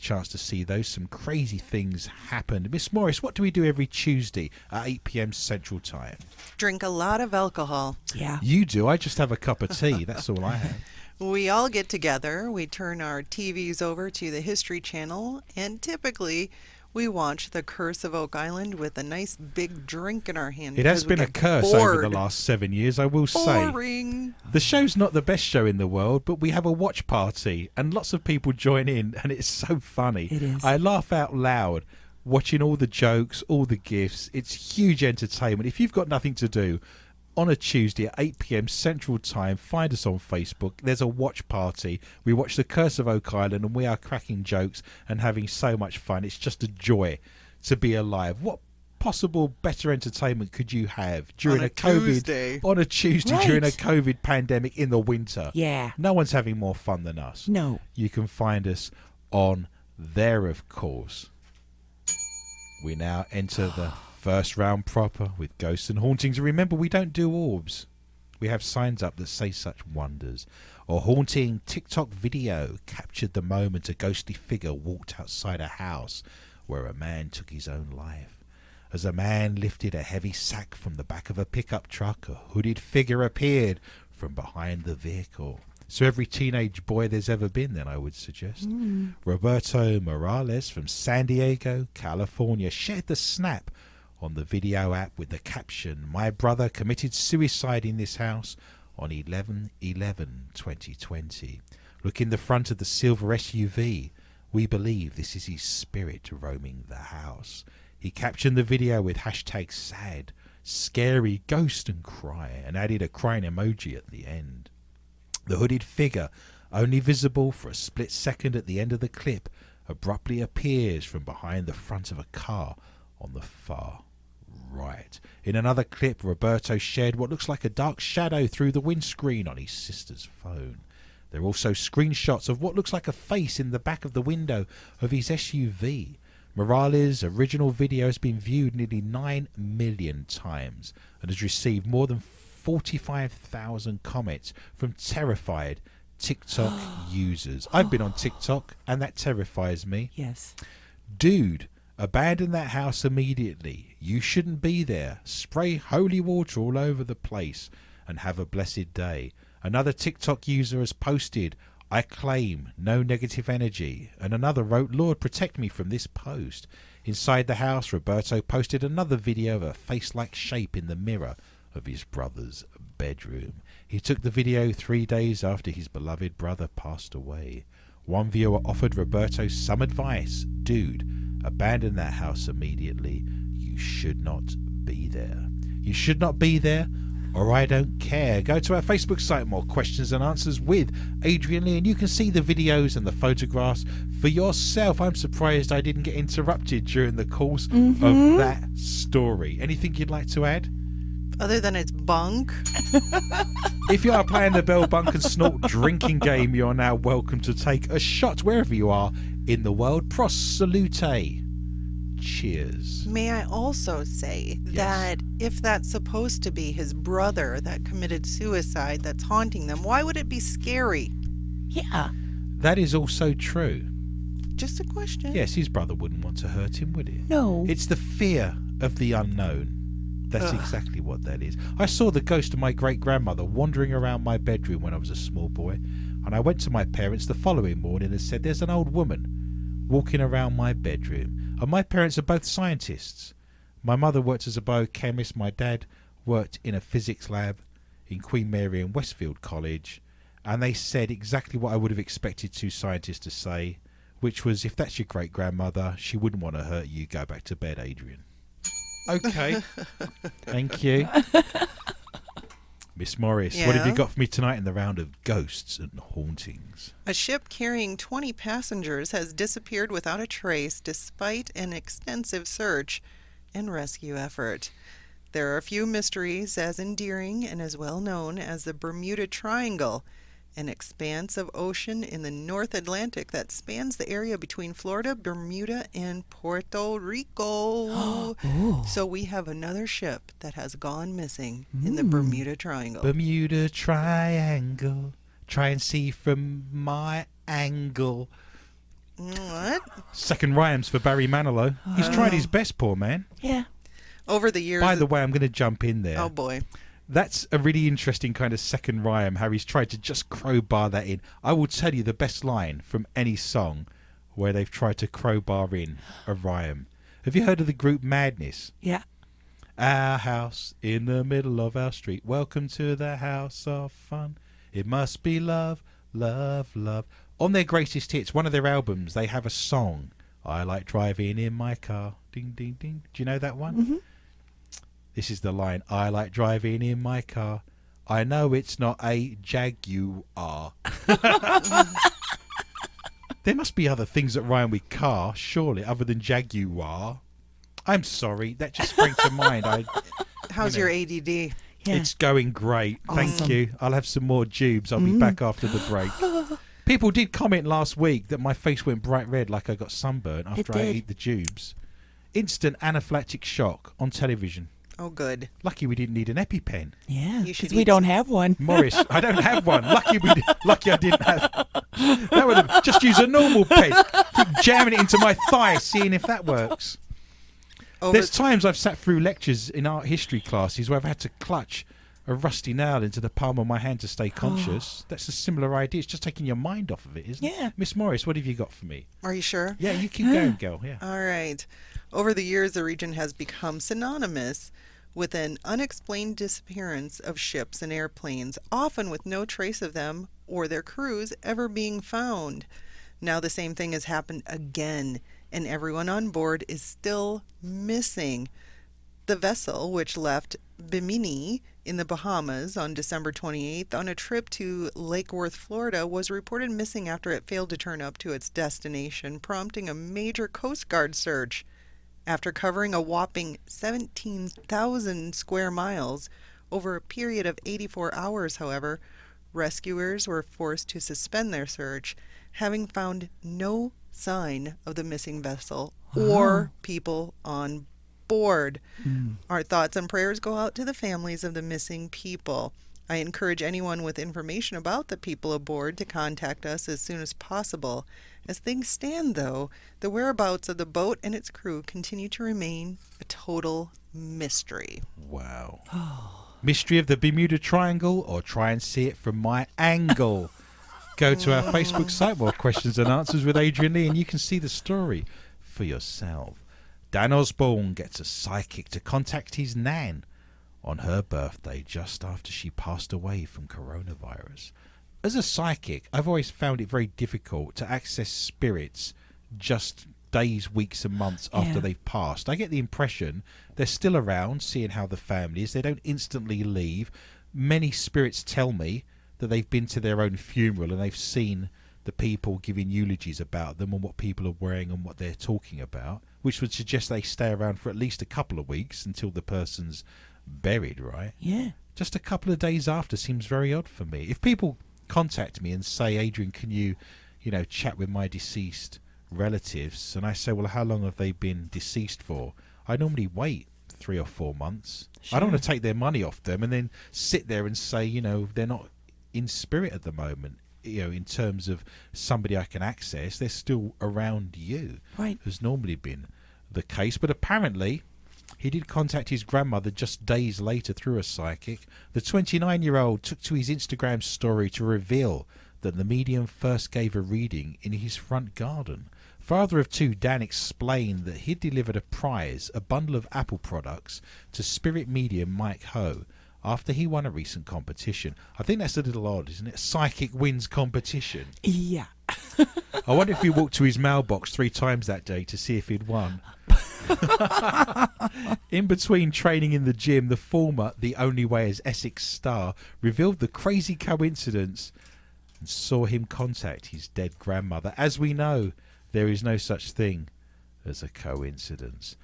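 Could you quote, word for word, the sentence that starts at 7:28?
As things stand, though, the whereabouts of the boat and its crew continue to remain a total mystery.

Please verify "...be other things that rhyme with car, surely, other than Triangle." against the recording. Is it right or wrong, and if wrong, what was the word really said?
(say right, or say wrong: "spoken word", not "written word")
wrong: "Jaguar", not "Triangle".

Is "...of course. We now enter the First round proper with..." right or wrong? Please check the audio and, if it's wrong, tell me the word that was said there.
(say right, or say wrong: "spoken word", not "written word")
right.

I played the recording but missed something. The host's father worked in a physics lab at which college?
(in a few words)
Queen Mary and Westfield College.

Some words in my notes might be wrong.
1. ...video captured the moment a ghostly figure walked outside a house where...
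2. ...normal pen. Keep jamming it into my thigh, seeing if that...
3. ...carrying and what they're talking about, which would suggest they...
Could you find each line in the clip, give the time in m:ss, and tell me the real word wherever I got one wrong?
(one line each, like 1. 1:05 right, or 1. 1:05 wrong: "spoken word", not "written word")
1. 1:12 right
2. 6:13 right
3. 8:14 wrong: "wearing", not "carrying".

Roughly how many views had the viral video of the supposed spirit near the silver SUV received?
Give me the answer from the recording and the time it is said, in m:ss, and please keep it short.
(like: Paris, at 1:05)
nearly 9 million, at 2:18.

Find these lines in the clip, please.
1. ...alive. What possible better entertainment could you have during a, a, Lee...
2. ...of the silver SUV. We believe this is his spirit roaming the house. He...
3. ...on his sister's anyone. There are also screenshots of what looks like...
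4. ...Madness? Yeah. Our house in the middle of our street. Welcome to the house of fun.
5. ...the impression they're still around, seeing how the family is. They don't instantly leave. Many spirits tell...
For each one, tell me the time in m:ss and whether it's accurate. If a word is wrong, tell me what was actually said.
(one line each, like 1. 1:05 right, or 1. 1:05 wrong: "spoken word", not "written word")
1. 0:47 wrong: "COVID", not "Lee"
2. 1:42 right
3. 2:09 wrong: "phone", not "anyone"
4. 5:18 right
5. 8:02 right.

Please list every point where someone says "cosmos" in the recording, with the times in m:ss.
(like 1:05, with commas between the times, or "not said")
not said.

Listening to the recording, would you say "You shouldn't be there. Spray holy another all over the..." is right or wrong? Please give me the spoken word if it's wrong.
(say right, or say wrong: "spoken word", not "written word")
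wrong: "water", not "another".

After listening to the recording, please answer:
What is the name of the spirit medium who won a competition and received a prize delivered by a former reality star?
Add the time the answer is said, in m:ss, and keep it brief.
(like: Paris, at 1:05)
Mike Ho, at 9:05.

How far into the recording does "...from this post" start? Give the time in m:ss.
2:45.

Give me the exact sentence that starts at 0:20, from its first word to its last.
It has been a curse bored.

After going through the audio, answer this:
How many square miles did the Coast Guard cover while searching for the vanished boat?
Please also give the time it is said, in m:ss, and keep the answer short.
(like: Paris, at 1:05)
17,000, at 7:03.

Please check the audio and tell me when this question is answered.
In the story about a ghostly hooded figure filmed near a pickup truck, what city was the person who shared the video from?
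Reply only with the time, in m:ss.
1:30.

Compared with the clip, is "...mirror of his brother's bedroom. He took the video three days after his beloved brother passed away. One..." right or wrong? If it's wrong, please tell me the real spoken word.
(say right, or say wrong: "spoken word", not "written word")
right.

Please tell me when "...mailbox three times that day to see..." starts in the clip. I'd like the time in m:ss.
9:13.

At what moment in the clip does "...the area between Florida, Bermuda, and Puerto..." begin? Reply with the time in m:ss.
4:43.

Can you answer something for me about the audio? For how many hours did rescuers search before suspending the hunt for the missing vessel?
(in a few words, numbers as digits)
84.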